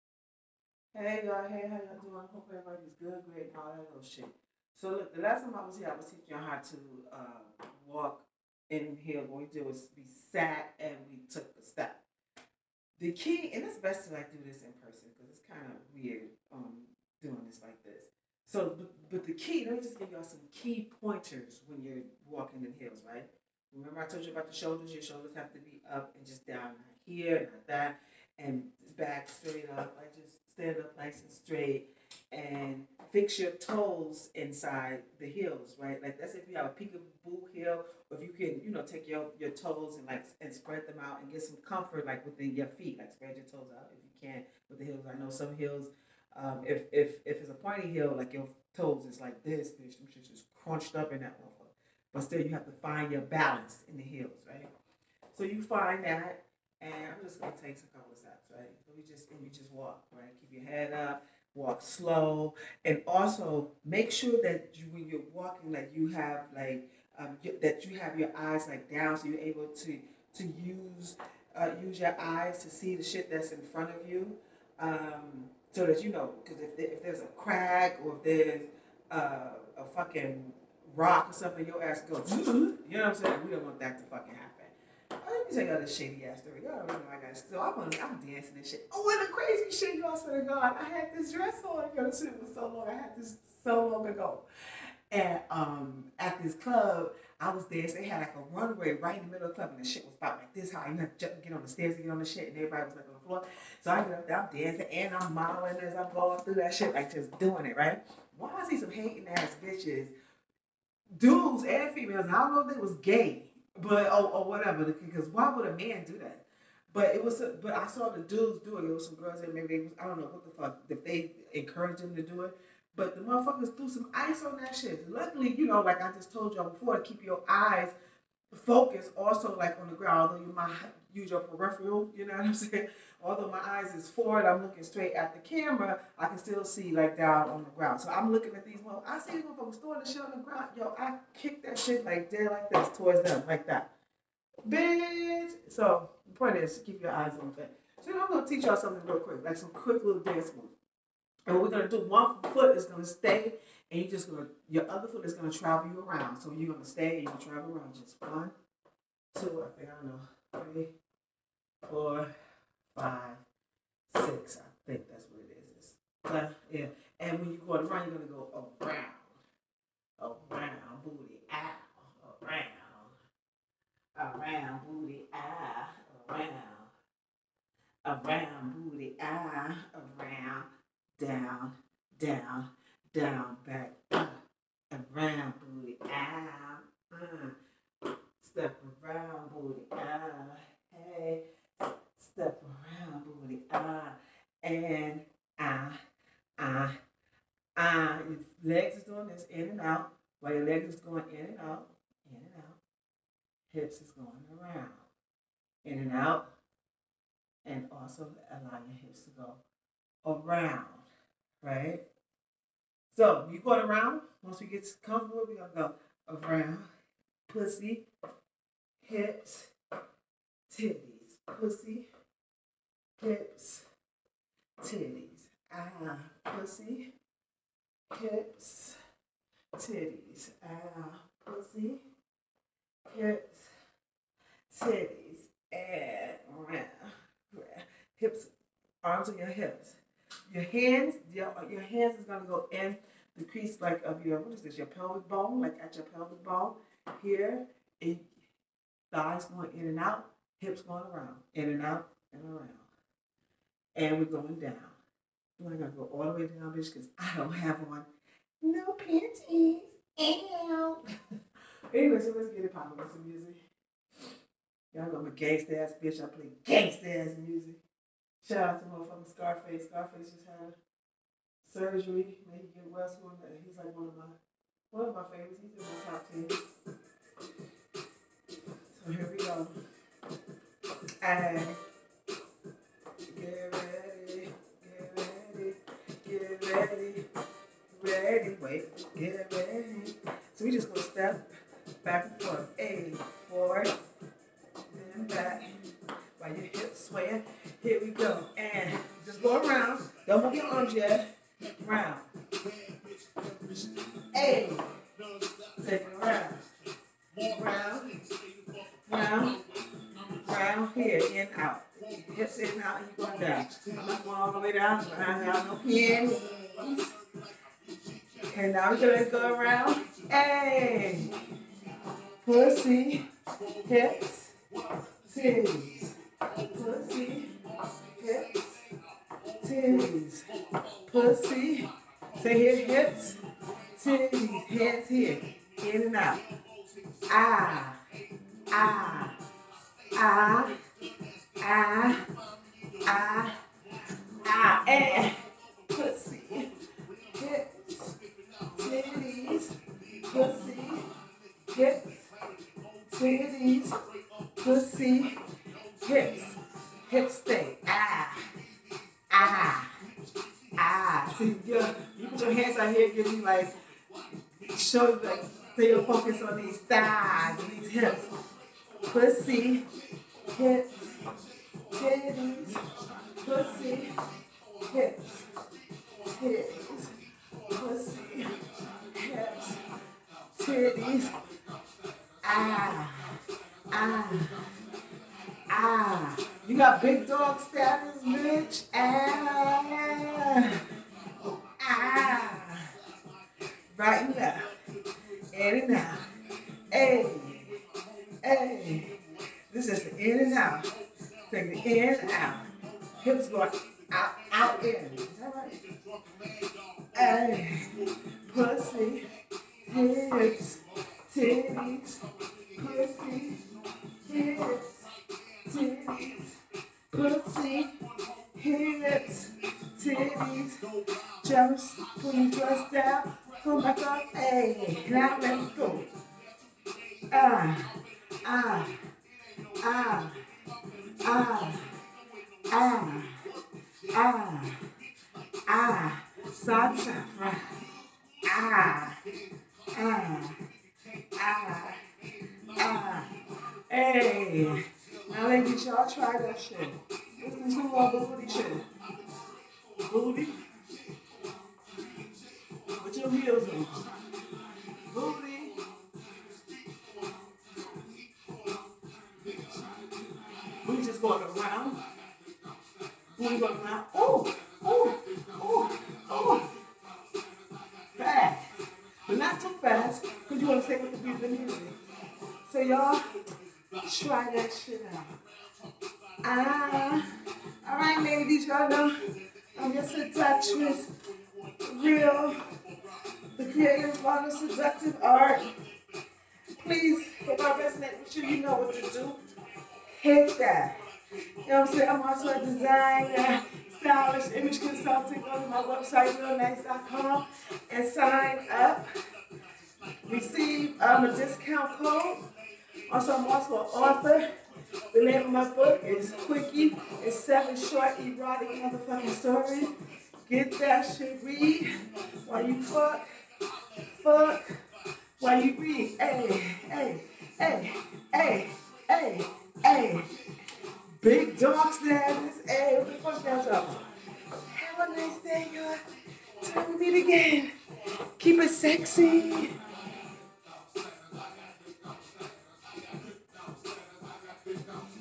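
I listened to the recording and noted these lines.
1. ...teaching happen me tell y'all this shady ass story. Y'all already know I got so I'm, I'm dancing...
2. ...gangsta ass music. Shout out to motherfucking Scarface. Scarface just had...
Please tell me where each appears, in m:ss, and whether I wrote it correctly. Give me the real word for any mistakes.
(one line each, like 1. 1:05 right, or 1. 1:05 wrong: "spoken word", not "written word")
1. 1:24 wrong: "fucking", not "teaching"
2. 4:26 right.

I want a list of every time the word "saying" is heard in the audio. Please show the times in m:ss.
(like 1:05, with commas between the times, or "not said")
1:23, 2:12, 8:11.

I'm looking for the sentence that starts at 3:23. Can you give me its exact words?
Hips is going around, in and out.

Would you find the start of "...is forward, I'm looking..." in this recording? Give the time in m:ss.
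2:13.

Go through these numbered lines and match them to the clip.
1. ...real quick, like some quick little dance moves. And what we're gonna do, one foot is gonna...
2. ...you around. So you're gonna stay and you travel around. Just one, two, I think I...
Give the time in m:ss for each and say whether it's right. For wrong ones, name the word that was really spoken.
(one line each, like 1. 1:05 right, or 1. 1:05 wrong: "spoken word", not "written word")
1. 2:29 right
2. 2:35 right.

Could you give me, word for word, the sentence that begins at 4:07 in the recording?
It, thighs going in and out, hips going around, in and out, and around.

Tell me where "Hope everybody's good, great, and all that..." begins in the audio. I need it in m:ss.
0:02.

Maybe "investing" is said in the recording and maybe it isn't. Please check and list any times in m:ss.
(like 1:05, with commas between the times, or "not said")
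not said.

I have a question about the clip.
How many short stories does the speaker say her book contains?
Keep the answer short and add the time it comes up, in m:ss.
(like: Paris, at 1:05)
7, at 8:27.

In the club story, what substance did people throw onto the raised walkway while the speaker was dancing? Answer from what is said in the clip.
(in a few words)
ice.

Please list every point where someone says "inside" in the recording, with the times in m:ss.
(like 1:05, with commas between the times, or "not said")
0:34.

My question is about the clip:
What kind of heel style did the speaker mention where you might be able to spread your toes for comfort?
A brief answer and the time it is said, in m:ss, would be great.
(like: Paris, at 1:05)
peekaboo heel, at 0:36.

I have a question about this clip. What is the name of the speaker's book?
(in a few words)
Quickie.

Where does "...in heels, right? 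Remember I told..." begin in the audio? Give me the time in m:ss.
0:22.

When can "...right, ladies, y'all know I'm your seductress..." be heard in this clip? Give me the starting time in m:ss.
7:57.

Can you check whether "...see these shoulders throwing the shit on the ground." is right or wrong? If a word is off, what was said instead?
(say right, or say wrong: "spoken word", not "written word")
wrong: "motherfuckers", not "shoulders".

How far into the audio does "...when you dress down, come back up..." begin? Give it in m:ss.
7:02.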